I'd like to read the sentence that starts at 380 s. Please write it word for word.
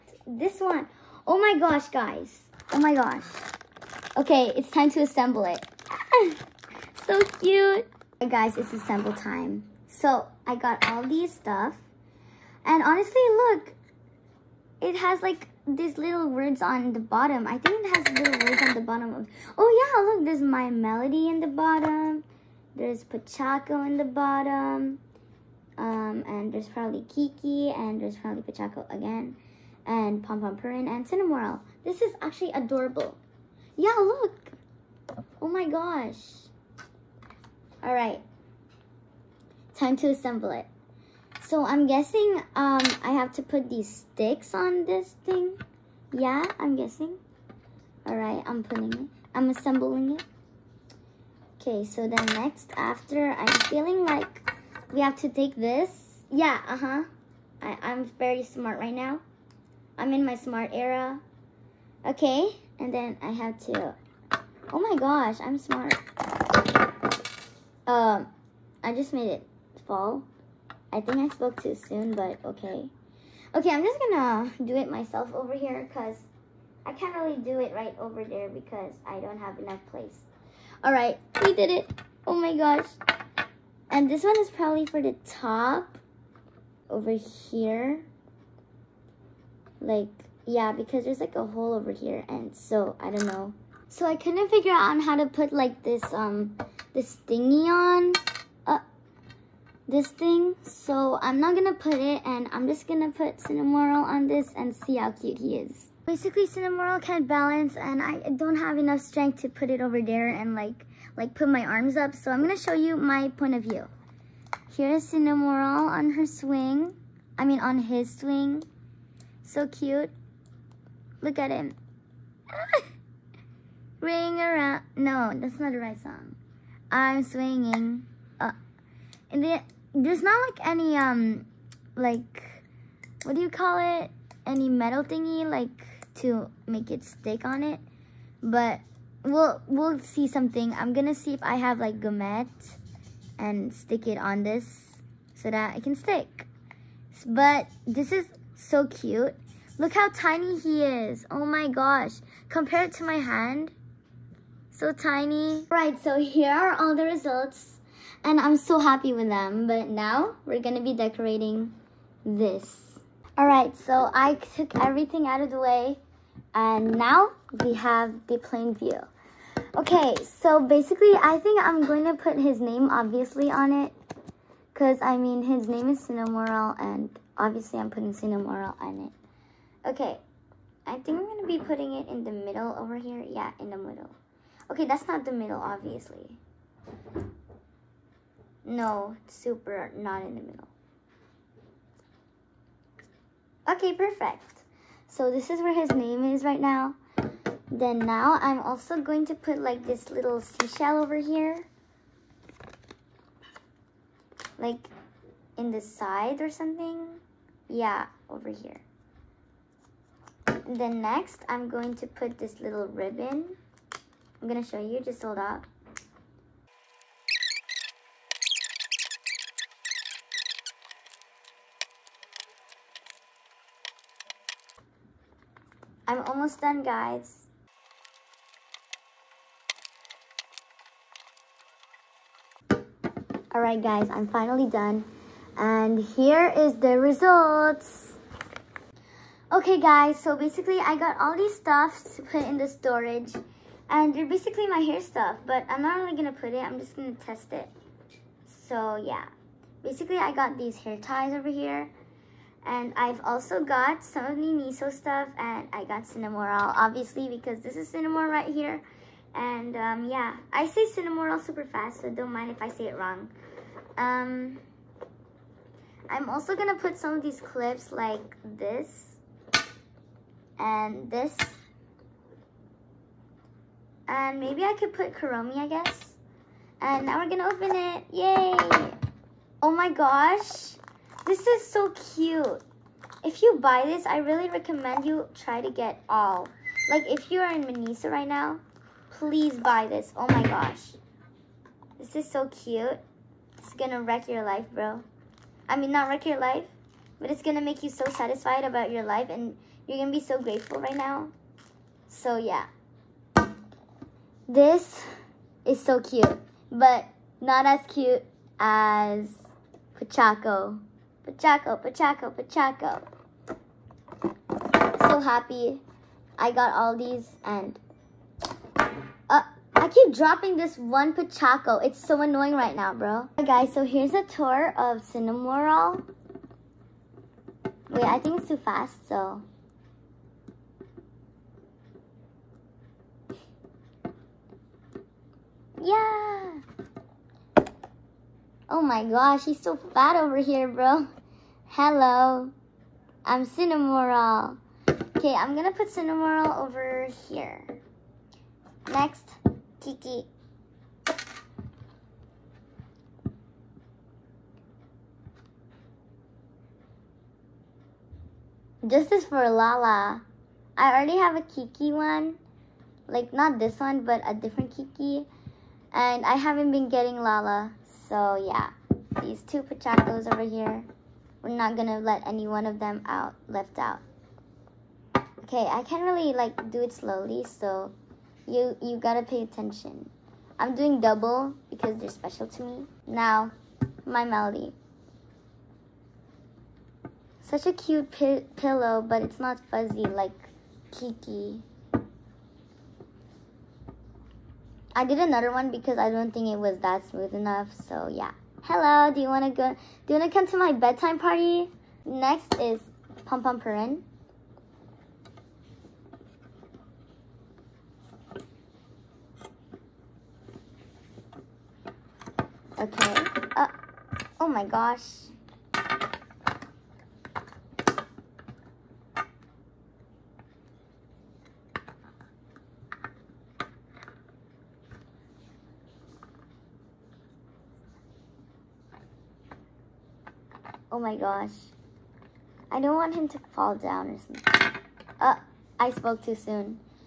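I'm doing double because they're special to me.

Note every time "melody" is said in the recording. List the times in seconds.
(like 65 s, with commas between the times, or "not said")
20 s, 384 s.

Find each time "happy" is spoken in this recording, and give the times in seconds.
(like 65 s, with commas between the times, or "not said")
158 s, 315 s.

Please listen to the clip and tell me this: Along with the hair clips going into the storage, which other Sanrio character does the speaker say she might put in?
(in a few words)
Kuromi.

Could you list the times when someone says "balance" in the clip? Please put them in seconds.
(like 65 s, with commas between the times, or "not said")
107 s.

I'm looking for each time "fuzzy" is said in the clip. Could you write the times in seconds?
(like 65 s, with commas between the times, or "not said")
389 s.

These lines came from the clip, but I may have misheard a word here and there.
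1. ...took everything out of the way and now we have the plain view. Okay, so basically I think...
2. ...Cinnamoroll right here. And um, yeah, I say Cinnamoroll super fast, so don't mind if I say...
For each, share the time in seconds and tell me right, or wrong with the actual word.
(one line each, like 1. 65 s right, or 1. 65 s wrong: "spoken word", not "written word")
1. 164 s right
2. 257 s right.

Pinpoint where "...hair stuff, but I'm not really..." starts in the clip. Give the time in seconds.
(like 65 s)
244 s.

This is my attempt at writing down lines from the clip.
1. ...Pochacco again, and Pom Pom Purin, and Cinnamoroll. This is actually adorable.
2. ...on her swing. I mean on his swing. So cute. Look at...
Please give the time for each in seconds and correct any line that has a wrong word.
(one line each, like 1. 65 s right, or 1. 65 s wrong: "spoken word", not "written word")
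1. 28 s right
2. 115 s right.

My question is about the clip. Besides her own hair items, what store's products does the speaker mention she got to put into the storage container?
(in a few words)
Miniso.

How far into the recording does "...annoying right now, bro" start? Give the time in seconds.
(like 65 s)
322 s.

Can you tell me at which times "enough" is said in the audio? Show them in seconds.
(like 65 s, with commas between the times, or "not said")
79 s, 108 s, 397 s.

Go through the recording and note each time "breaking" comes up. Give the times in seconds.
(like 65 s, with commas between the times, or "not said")
not said.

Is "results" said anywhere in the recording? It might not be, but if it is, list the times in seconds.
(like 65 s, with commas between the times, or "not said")
157 s, 236 s.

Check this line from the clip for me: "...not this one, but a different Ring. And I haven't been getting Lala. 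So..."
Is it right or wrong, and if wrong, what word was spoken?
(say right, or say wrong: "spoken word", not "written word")
wrong: "Kiki", not "Ring".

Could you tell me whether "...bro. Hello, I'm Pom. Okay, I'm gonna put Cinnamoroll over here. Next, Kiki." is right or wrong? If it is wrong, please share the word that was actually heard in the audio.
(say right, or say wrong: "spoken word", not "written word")
wrong: "Cinnamoroll", not "Pom".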